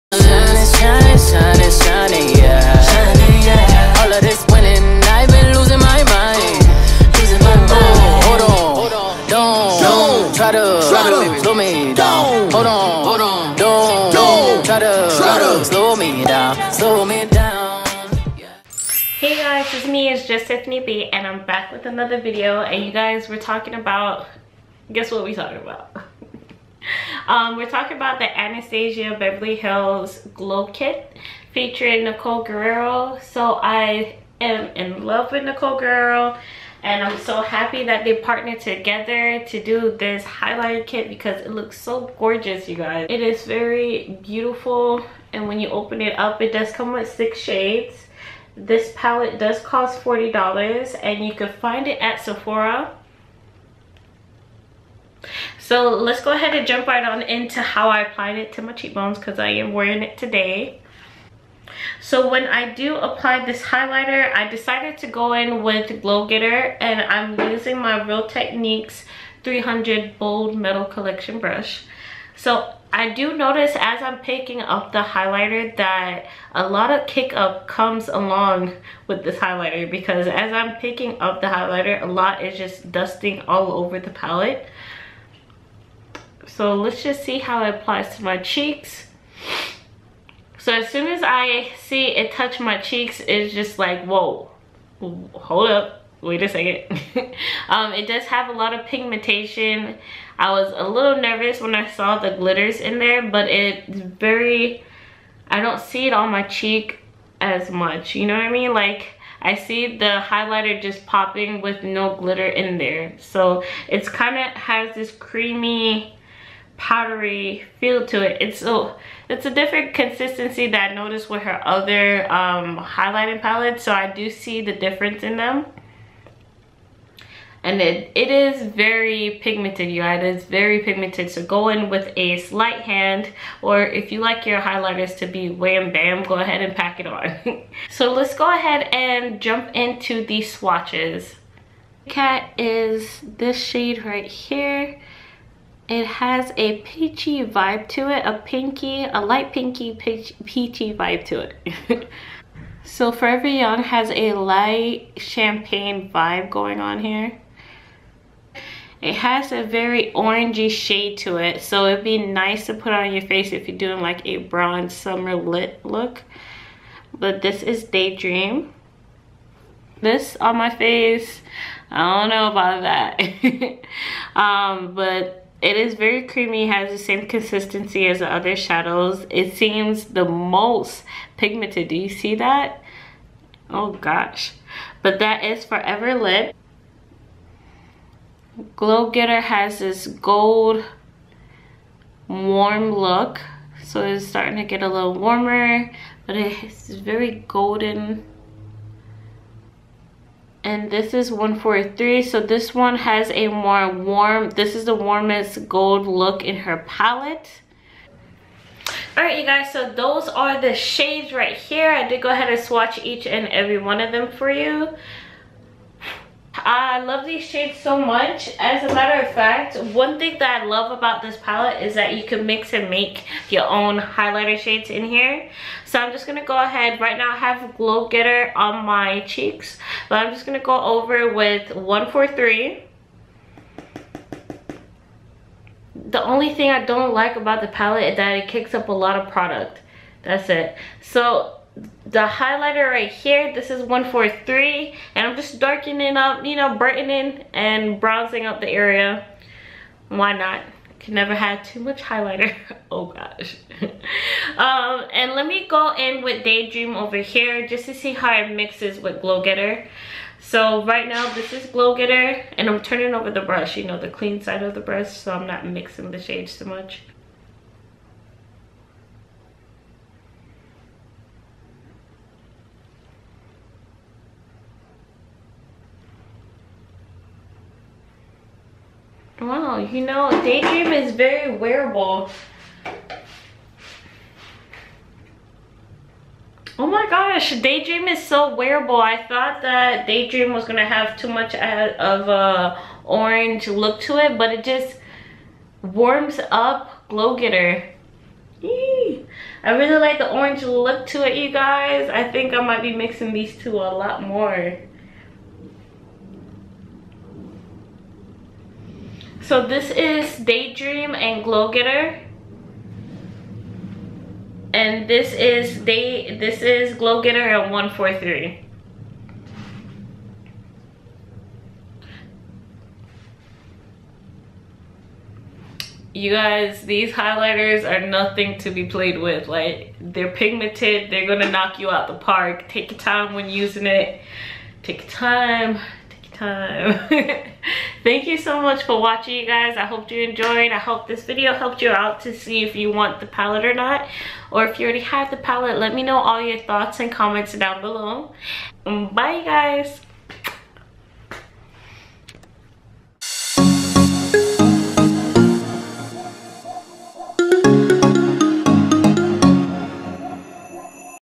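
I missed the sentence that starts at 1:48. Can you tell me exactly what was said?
Like, I see the highlighter just popping with no glitter in there.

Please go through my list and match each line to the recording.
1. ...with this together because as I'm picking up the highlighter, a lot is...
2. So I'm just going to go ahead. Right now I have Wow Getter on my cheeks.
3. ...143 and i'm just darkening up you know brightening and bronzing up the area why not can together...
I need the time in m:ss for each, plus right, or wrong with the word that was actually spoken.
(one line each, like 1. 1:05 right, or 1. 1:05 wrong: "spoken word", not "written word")
1. 1:19 wrong: "highlighter", not "together"
2. 3:45 wrong: "Glo", not "Wow"
3. 4:03 wrong: "never", not "together".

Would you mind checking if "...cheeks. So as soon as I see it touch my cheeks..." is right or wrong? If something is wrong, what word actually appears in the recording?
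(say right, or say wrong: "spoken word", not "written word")
right.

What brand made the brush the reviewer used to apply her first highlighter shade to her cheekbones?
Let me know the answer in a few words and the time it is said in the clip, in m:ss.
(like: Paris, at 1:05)
Real Techniques, at 1:08.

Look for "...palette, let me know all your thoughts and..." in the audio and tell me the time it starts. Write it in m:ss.
5:45.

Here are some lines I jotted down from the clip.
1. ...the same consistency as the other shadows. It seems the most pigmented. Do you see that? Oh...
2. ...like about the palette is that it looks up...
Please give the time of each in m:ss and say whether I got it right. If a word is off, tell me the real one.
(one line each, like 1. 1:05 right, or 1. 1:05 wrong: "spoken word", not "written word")
1. 2:56 right
2. 3:57 wrong: "kicks", not "looks".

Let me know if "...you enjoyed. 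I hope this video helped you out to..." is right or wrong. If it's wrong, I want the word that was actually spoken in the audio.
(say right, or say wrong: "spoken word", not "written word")
right.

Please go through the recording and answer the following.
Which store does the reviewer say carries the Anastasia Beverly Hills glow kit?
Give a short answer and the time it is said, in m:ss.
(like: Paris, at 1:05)
Sephora, at 0:52.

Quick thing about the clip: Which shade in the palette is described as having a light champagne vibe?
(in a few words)
Forever Young.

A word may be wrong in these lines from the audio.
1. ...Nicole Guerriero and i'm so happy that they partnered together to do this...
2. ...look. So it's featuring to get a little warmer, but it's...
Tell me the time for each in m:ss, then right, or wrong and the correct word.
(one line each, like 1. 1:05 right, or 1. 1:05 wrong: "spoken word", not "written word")
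1. 0:35 right
2. 3:12 wrong: "starting", not "featuring".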